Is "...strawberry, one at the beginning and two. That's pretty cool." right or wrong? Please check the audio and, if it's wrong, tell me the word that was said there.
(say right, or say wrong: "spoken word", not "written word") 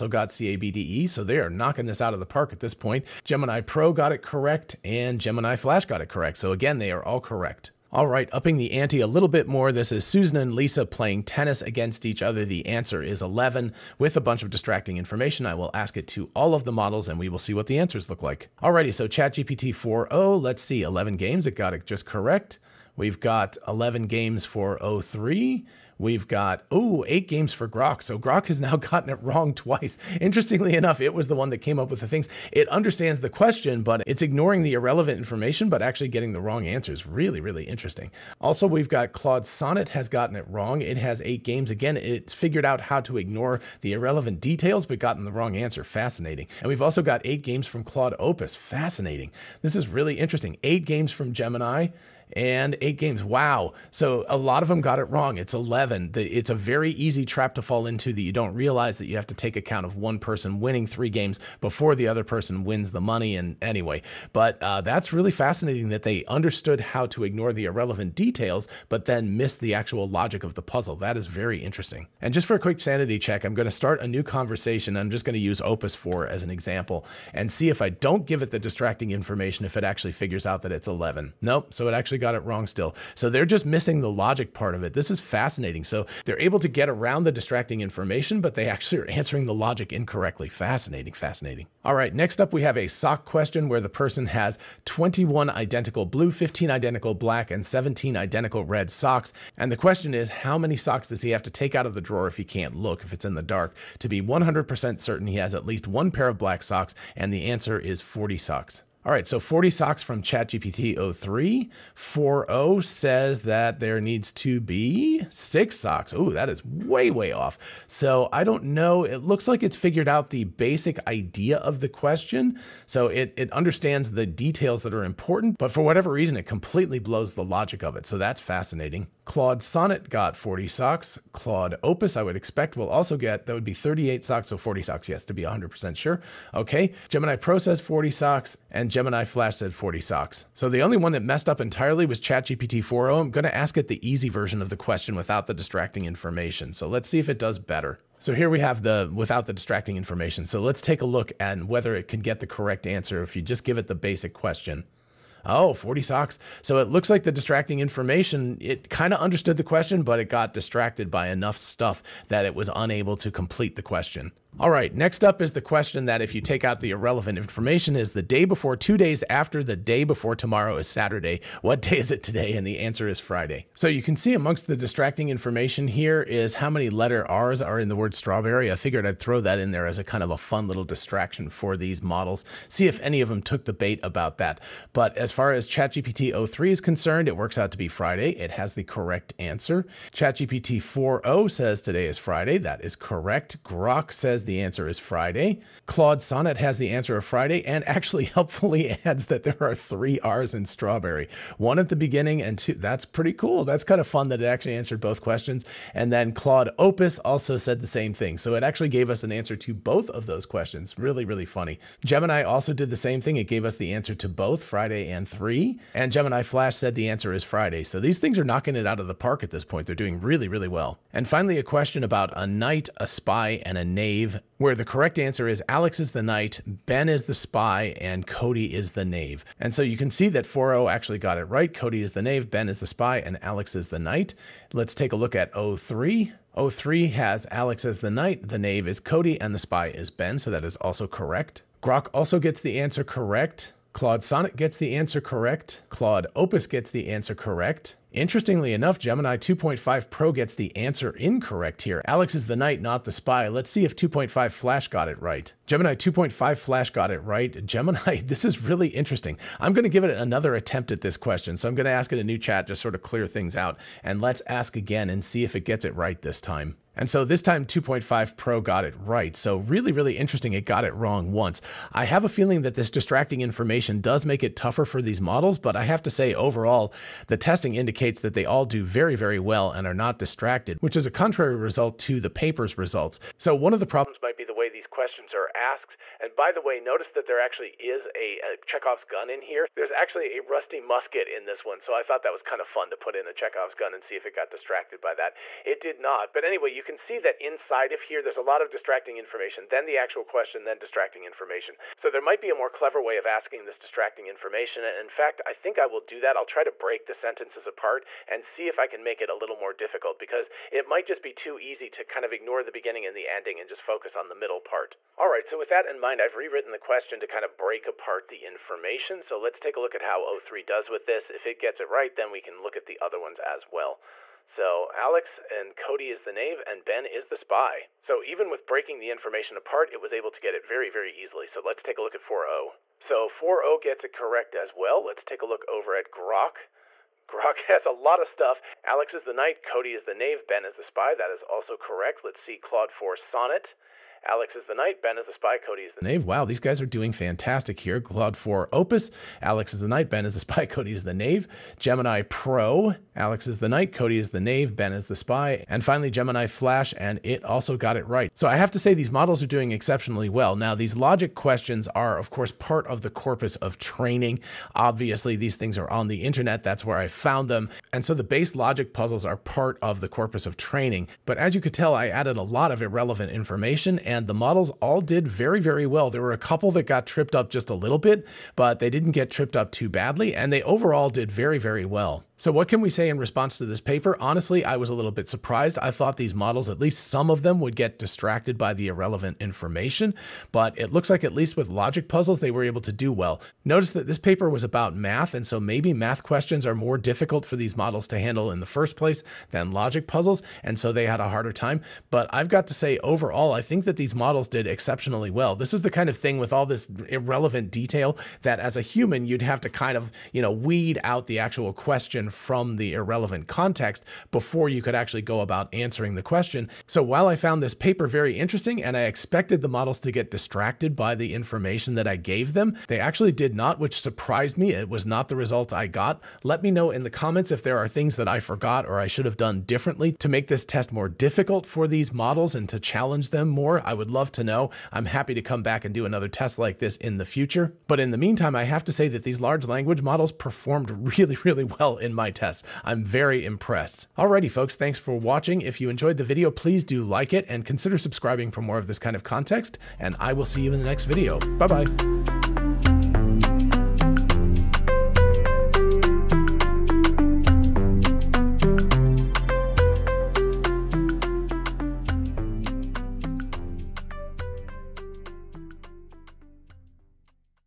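right.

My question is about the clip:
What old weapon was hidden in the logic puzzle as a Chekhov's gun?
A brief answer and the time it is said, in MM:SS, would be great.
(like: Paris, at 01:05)
rusty musket, at 04:50.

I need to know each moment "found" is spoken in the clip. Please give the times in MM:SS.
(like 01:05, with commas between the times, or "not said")
06:07, 06:57.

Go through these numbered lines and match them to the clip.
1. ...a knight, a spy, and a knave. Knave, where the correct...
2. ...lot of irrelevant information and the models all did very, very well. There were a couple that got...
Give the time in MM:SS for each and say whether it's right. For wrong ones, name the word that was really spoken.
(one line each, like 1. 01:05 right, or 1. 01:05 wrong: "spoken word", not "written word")
1. 03:42 right
2. 06:12 right.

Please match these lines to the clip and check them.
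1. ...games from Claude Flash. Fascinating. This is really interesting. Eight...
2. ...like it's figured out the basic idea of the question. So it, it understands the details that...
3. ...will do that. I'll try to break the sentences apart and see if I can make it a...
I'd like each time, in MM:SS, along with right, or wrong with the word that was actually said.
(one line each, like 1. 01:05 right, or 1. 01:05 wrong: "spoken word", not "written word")
1. 00:47 wrong: "Opus", not "Flash"
2. 01:59 right
3. 05:05 right.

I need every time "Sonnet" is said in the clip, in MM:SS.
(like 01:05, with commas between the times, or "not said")
00:39, 02:09, 03:16, 04:04, 05:43.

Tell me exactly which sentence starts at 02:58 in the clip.
I figured I'd throw that in there as a kind of a fun little distraction for these models.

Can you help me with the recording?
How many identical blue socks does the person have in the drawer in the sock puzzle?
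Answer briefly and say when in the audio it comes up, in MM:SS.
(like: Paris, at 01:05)
21, at 01:34.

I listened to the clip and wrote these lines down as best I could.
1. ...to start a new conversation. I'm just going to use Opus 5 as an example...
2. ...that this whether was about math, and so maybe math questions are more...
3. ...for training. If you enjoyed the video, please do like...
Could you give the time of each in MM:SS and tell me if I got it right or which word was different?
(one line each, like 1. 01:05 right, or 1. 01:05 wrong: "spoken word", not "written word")
1. 01:13 wrong: "4", not "5"
2. 06:33 wrong: "paper", not "whether"
3. 07:24 wrong: "watching", not "training".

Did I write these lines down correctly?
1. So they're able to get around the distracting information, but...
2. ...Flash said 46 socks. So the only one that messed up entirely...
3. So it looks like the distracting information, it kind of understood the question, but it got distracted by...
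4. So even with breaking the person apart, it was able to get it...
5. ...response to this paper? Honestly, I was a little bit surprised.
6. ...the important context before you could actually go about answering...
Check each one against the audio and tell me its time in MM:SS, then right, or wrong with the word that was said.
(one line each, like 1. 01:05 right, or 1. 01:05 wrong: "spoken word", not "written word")
1. 01:25 right
2. 02:19 wrong: "40", not "46"
3. 02:36 right
4. 05:28 wrong: "information", not "person"
5. 06:23 right
6. 06:52 wrong: "irrelevant", not "important".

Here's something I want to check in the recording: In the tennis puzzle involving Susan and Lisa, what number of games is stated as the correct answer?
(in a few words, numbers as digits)
11.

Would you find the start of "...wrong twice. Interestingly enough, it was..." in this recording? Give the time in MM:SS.
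00:29.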